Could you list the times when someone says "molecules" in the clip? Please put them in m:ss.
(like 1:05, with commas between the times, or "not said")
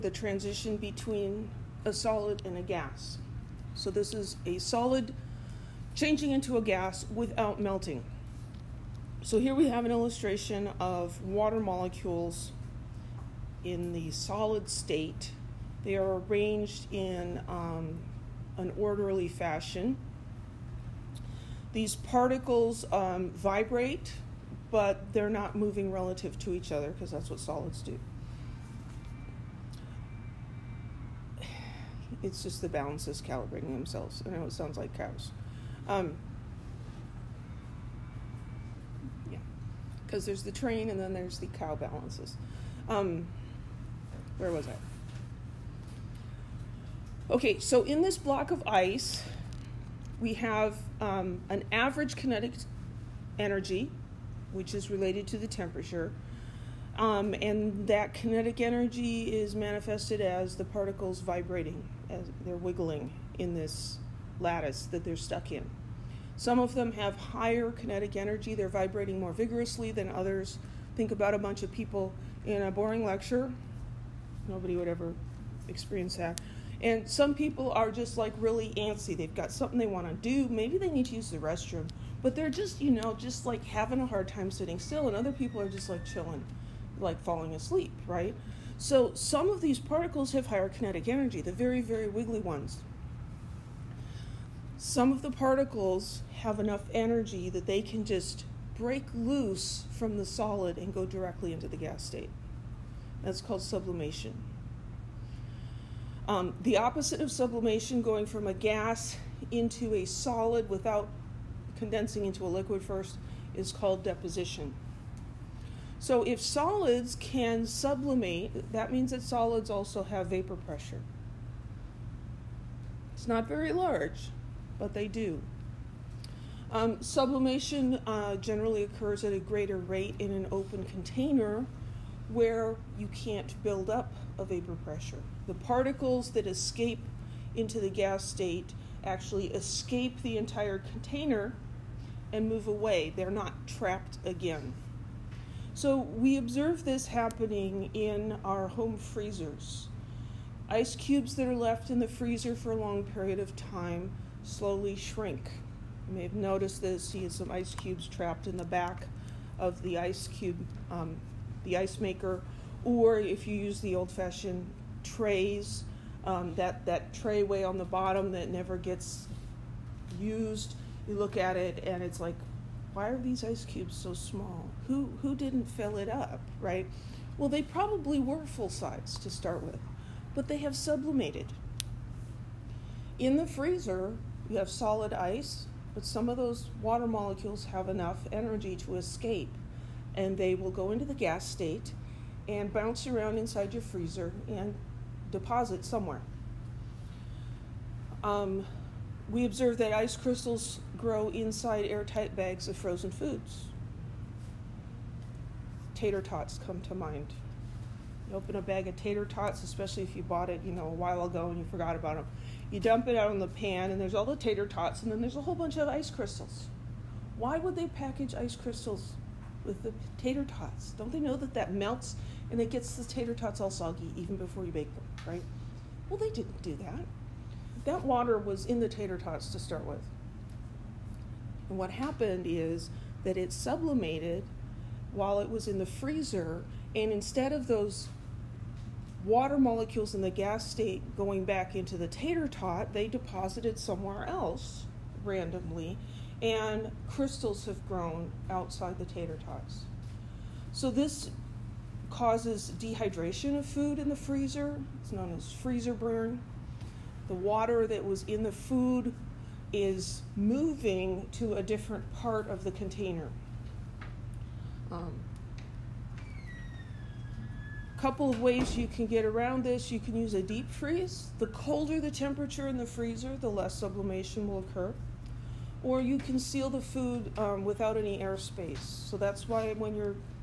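0:11, 3:07, 3:59.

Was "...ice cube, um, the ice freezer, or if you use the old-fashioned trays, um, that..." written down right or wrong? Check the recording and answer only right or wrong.
wrong.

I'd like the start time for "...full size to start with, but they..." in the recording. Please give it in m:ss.
2:58.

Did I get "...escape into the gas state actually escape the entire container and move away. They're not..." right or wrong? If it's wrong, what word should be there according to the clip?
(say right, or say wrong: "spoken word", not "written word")
right.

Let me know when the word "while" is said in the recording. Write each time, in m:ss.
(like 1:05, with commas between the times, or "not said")
3:30, 3:55.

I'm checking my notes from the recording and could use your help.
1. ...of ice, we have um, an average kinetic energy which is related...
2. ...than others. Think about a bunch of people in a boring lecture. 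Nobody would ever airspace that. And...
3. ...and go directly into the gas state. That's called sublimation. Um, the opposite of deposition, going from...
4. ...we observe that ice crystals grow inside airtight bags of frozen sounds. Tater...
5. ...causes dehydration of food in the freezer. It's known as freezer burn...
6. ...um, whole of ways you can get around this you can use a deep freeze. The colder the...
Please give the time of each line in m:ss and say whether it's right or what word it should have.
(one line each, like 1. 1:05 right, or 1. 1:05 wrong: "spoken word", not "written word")
1. 0:48 right
2. 1:09 wrong: "experience", not "airspace"
3. 1:40 wrong: "sublimation", not "deposition"
4. 3:19 wrong: "foods", not "sounds"
5. 4:12 right
6. 4:24 wrong: "couple", not "whole".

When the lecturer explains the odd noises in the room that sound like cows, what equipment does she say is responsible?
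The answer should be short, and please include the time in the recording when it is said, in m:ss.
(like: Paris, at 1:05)
The balances, at 0:32.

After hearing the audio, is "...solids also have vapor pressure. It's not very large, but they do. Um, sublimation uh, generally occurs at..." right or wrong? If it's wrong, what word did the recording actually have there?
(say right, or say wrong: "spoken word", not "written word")
right.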